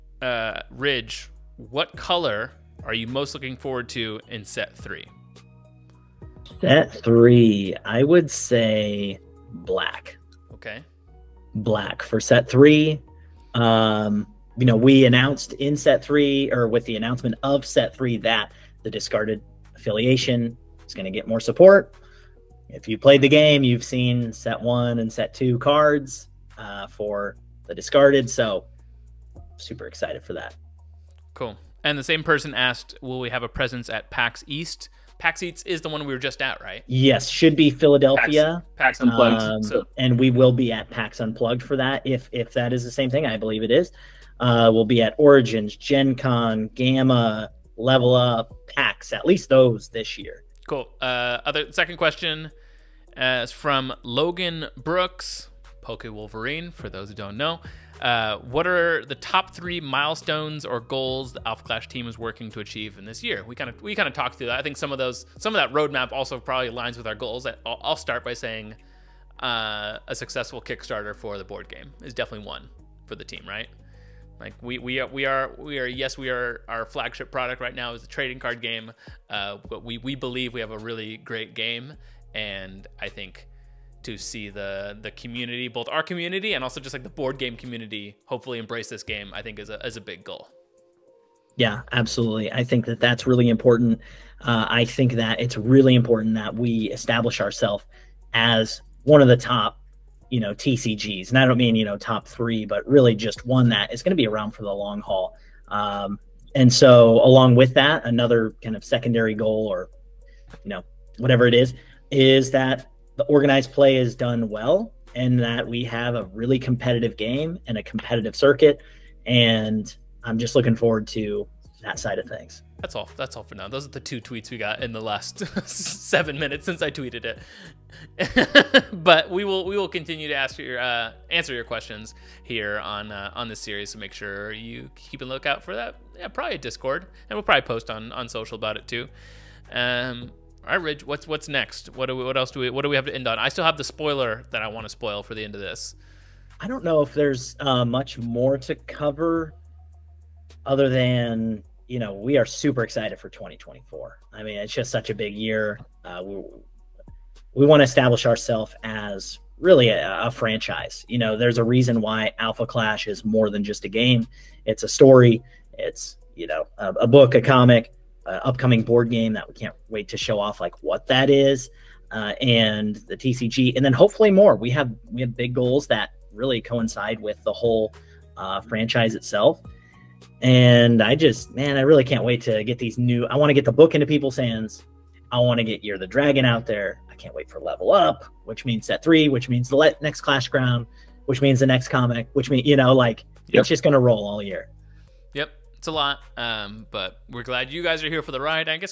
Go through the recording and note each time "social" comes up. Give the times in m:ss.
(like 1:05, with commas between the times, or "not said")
2:18.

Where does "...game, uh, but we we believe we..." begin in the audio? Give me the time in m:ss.
1:18.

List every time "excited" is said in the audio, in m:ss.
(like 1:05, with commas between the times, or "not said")
0:29, 2:32.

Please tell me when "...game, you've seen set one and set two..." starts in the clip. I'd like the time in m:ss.
0:23.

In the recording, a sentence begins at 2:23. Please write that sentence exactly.
I still have the spoiler that I want to spoil for the end of this.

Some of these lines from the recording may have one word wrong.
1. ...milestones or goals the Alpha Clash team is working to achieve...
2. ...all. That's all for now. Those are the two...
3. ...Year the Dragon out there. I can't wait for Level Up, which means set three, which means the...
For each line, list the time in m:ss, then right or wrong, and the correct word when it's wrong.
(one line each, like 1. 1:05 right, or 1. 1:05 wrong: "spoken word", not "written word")
1. 0:59 right
2. 2:02 right
3. 3:05 right.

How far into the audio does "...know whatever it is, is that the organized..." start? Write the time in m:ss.
1:50.